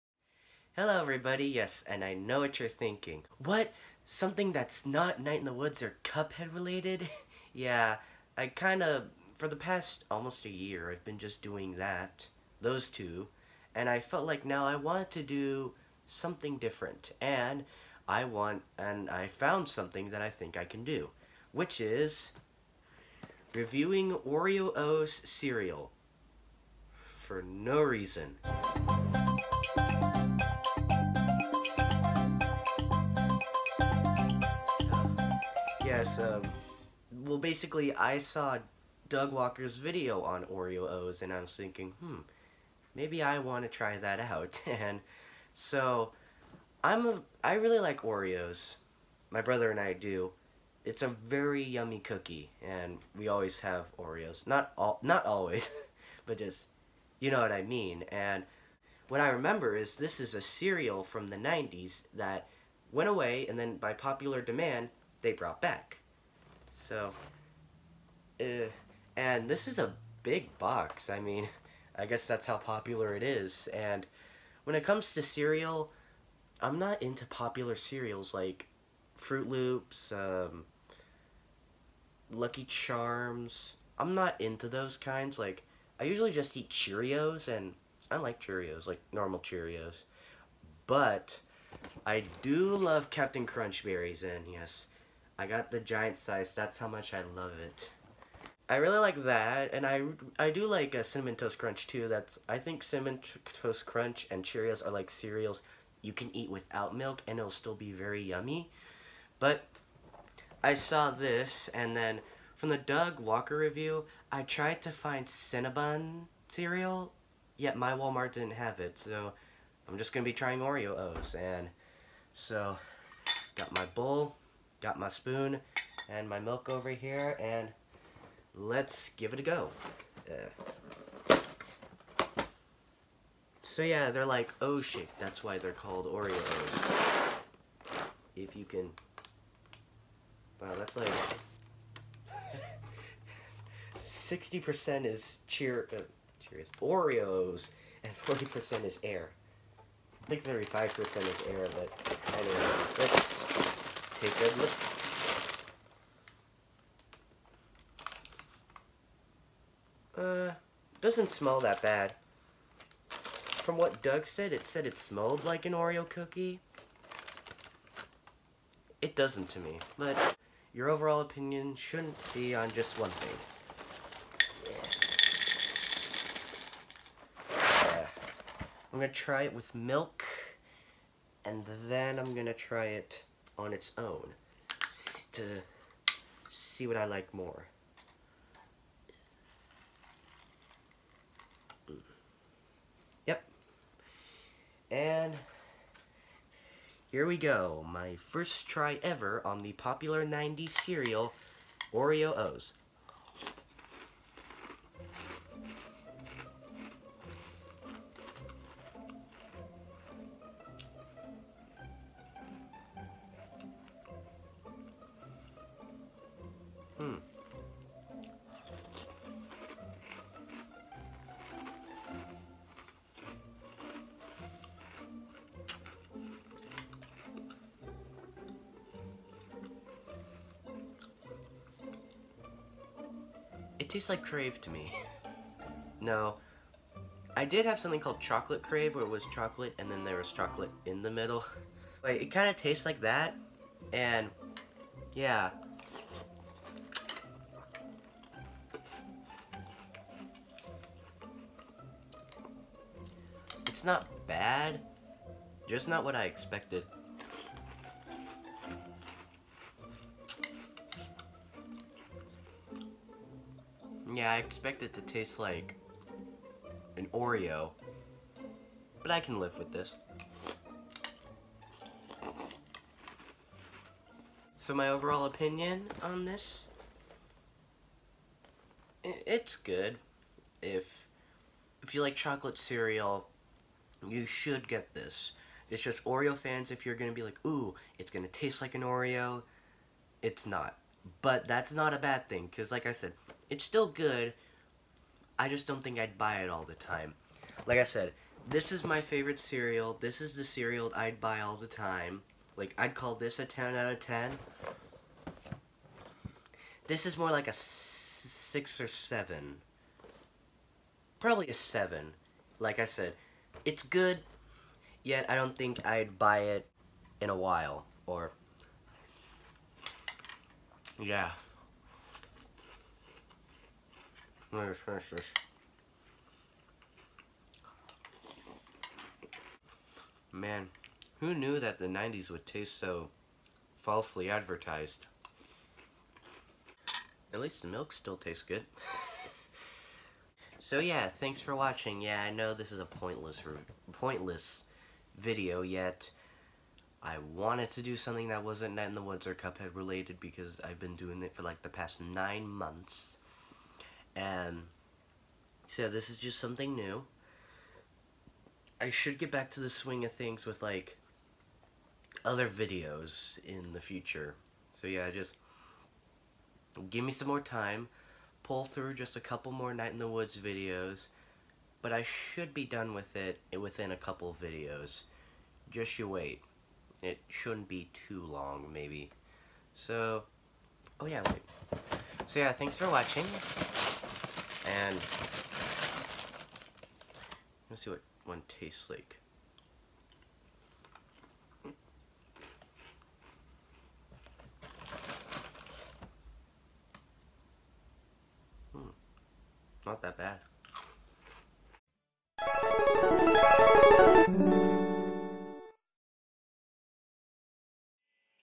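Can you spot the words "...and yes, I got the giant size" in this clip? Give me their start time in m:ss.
1:34.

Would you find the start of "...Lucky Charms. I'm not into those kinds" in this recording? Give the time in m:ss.
1:22.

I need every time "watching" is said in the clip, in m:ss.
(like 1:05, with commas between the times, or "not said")
5:41, 6:22.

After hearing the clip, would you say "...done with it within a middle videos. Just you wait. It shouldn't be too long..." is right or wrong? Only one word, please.
wrong.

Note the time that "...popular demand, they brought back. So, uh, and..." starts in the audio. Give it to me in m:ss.
1:03.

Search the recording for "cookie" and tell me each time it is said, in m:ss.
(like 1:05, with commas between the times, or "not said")
0:51, 2:46.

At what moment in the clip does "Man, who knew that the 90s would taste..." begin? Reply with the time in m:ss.
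5:30.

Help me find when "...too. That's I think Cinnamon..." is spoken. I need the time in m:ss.
1:41.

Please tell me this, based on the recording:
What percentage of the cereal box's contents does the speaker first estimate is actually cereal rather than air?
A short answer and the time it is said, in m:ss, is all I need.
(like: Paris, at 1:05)
60%, at 2:24.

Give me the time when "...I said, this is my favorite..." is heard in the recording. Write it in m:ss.
4:57.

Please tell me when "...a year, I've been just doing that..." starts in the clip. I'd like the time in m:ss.
0:10.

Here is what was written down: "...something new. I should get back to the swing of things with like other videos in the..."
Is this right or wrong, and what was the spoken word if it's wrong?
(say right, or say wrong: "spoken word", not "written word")
right.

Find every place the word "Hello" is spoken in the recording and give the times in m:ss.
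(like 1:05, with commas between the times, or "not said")
0:00.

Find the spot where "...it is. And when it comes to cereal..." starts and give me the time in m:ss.
1:13.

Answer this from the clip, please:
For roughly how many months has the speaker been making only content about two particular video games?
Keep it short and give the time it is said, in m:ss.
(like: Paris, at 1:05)
9, at 5:52.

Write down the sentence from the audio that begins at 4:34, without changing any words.
So my overall opinion on this, it's good.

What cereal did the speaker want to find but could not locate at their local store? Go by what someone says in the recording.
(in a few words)
Cinnabon cereal.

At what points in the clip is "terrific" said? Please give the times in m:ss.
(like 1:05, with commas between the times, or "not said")
not said.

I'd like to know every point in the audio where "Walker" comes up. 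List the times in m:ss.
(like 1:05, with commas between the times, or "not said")
0:39, 1:53.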